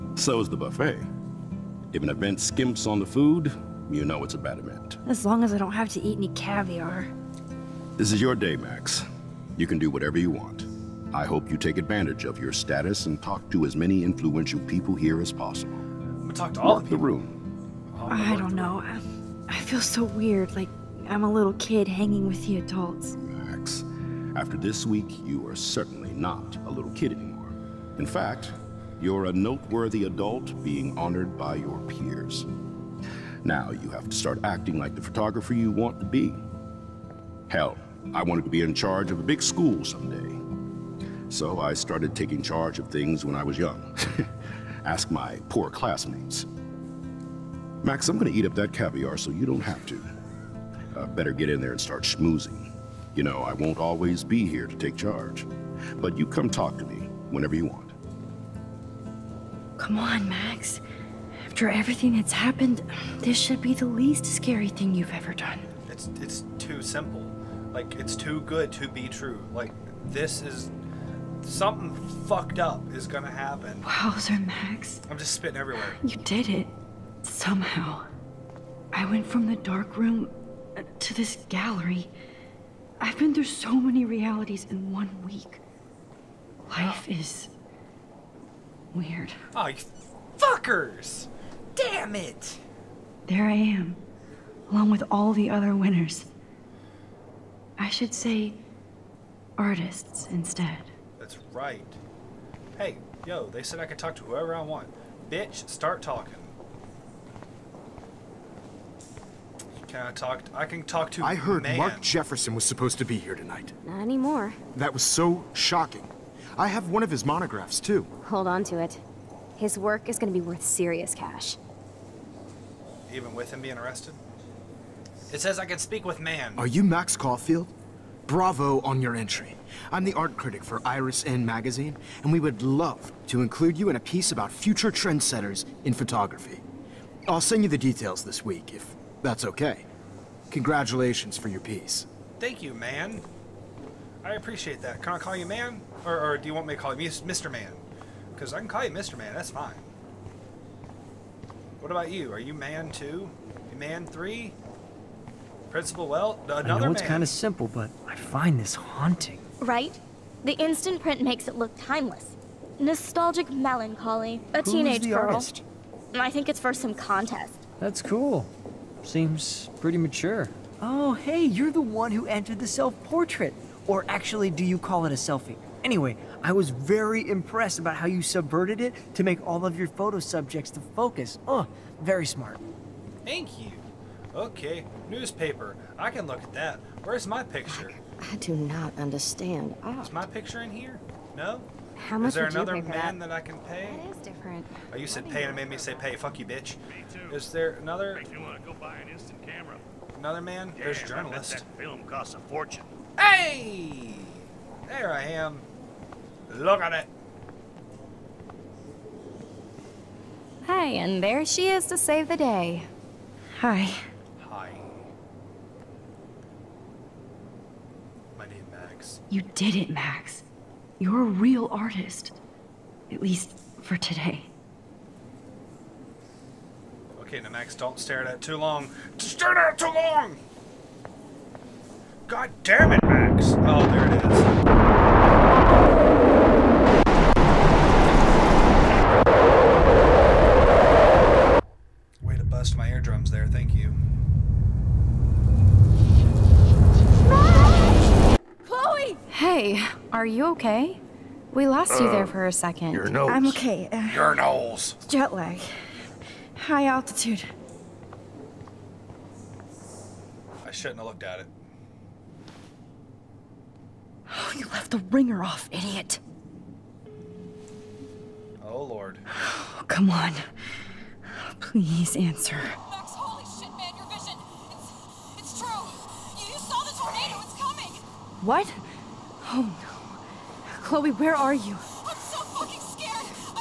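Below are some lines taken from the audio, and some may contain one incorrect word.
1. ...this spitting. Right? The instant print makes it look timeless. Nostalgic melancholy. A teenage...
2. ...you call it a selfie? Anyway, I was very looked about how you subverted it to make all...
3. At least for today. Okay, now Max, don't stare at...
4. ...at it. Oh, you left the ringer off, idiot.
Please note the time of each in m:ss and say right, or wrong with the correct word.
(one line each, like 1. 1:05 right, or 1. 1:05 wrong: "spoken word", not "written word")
1. 2:38 wrong: "haunting", not "spitting"
2. 2:54 wrong: "impressed", not "looked"
3. 3:43 right
4. 4:21 right.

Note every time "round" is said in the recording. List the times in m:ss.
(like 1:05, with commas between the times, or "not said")
not said.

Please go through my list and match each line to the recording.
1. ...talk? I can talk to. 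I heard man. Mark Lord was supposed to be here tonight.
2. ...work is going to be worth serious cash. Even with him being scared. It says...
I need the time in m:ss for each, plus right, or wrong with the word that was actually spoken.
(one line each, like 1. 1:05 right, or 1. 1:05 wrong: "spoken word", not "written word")
1. 1:50 wrong: "Jefferson", not "Lord"
2. 1:59 wrong: "arrested", not "scared".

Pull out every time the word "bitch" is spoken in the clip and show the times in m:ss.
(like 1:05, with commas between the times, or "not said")
1:45, 3:16.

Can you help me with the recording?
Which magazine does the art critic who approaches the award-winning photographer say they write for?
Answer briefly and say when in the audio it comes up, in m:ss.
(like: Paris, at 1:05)
Iris N, at 2:10.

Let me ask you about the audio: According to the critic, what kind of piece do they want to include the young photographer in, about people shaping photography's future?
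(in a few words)
future trendsetters.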